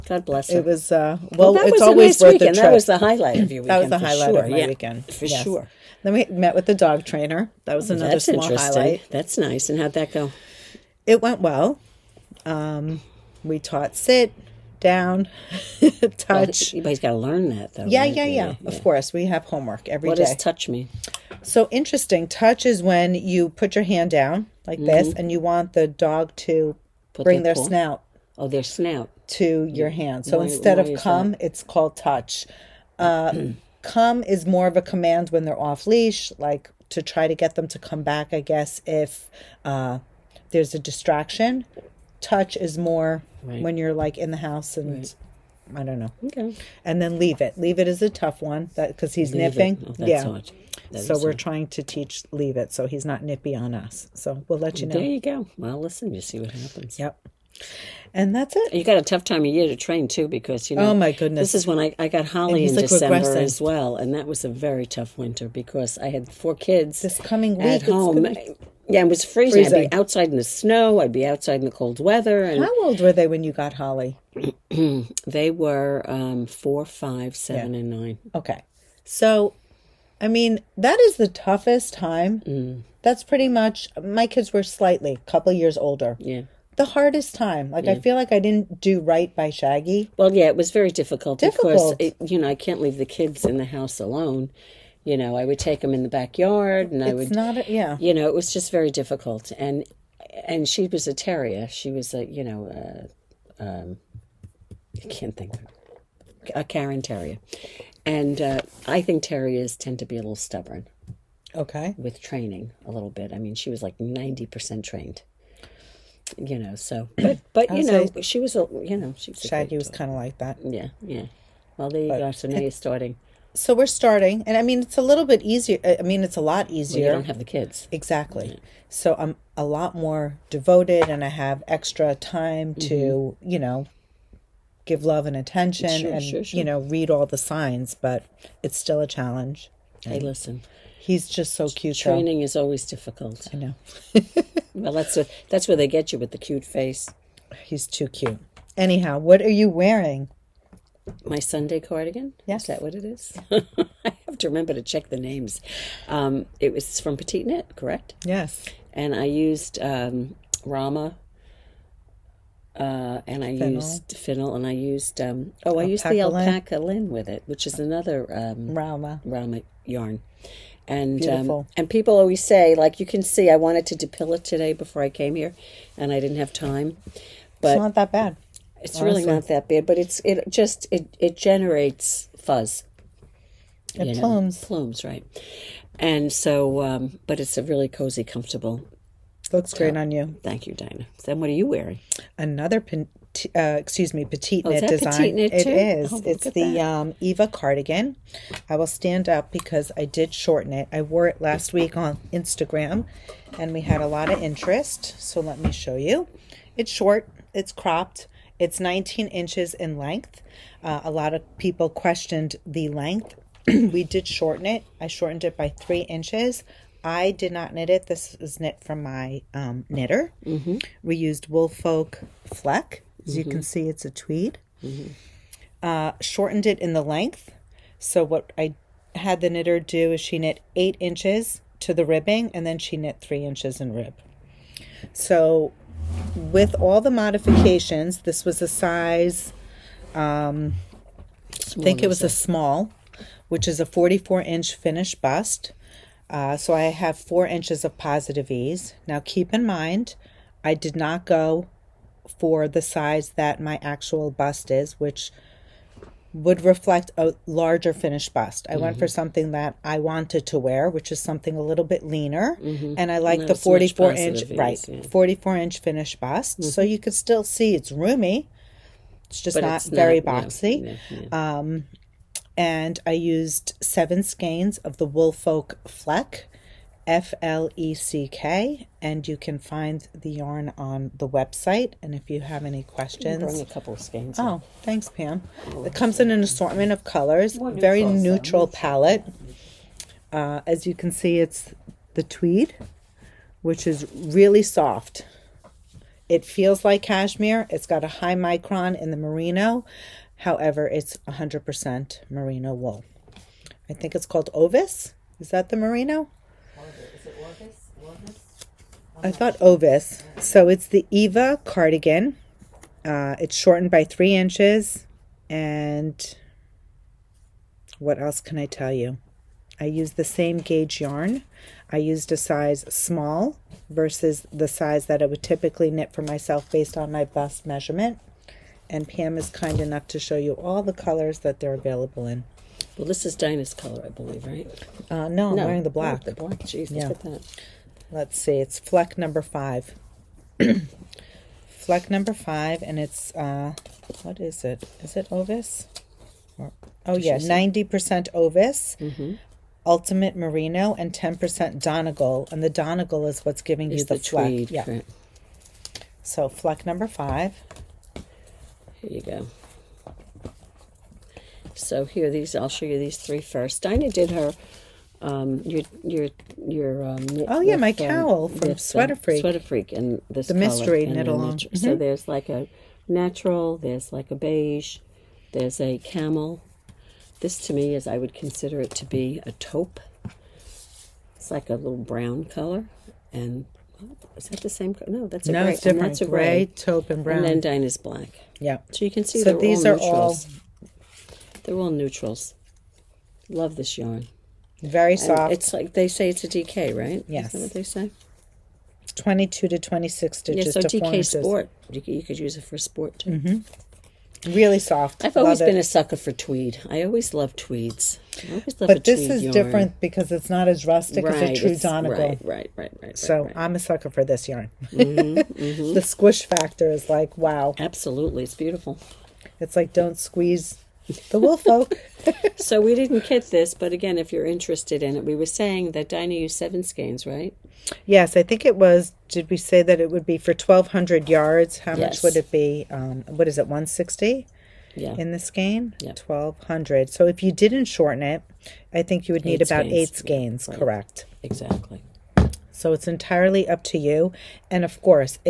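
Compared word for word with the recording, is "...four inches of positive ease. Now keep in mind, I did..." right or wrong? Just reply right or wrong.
right.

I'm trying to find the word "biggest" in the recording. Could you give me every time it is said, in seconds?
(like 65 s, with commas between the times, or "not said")
not said.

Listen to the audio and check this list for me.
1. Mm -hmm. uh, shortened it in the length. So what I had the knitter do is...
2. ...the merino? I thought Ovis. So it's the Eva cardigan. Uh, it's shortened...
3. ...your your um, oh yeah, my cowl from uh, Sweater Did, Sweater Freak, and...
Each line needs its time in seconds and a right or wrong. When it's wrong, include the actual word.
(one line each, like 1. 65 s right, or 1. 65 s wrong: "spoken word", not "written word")
1. 224 s right
2. 305 s right
3. 366 s wrong: "Freak", not "Did".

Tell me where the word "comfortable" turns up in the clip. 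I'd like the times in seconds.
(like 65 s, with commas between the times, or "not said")
188 s.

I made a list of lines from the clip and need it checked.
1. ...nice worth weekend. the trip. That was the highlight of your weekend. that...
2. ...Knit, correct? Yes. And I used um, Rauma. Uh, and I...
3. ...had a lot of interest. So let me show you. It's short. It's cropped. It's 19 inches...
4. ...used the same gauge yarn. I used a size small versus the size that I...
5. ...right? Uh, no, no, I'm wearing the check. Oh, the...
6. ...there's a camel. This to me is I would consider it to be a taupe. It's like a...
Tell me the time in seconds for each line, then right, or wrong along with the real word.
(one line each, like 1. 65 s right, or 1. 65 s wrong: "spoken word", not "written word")
1. 2 s right
2. 157 s right
3. 203 s right
4. 319 s right
5. 334 s wrong: "black", not "check"
6. 375 s right.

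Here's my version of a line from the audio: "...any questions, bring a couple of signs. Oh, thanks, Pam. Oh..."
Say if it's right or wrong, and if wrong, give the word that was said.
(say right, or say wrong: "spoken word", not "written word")
wrong: "skeins", not "signs".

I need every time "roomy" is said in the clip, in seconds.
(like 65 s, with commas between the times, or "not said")
267 s.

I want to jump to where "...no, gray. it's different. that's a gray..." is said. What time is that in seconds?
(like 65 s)
385 s.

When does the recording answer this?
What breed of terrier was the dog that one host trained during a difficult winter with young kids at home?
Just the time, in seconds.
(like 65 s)
106 s.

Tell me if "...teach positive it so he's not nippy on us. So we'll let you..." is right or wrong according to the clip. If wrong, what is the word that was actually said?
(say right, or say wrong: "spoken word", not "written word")
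wrong: "leave", not "positive".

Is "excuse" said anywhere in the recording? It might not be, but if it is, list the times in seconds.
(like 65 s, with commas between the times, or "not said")
193 s.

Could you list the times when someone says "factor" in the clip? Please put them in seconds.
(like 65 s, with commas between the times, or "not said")
416 s.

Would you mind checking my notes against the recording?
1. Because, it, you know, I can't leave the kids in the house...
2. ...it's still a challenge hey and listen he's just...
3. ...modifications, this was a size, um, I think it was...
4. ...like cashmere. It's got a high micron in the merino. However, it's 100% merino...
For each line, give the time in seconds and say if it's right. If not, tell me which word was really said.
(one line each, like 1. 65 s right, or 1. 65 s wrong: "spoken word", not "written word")
1. 91 s right
2. 138 s right
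3. 237 s right
4. 296 s right.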